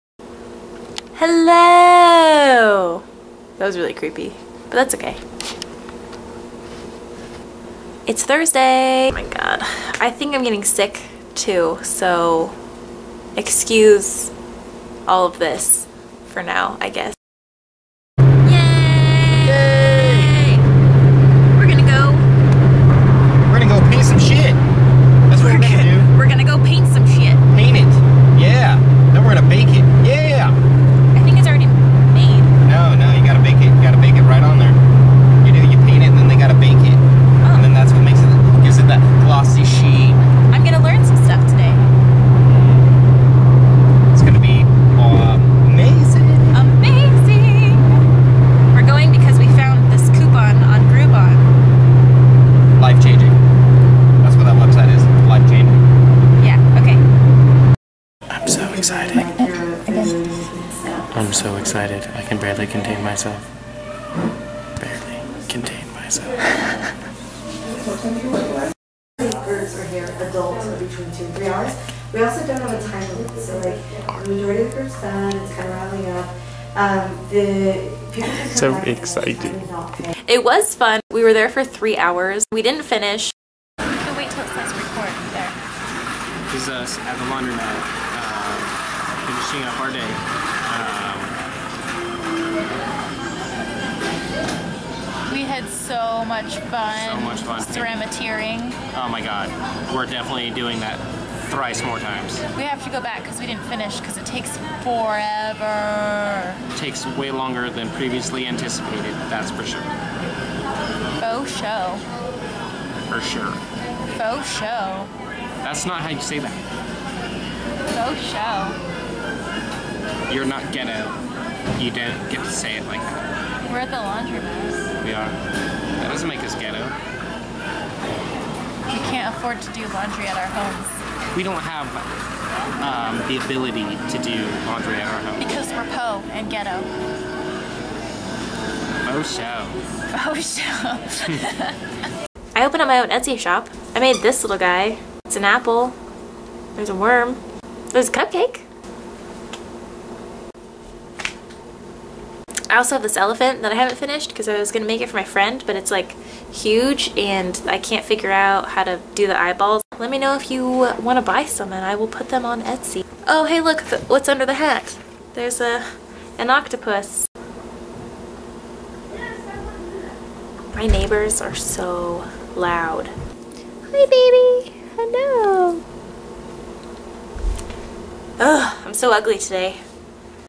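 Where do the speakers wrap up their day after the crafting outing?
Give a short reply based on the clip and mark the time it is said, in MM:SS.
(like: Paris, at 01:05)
the laundromat, at 01:27.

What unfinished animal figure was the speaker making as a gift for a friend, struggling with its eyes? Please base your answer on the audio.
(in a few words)
elephant.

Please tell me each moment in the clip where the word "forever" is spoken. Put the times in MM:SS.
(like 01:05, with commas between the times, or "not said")
01:44.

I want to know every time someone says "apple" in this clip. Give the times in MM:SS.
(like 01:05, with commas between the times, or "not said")
02:25.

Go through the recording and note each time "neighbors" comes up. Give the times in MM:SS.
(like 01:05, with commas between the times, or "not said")
02:50.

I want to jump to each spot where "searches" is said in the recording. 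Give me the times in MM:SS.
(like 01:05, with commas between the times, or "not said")
not said.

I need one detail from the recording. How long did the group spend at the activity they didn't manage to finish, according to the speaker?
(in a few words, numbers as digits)
3 hours.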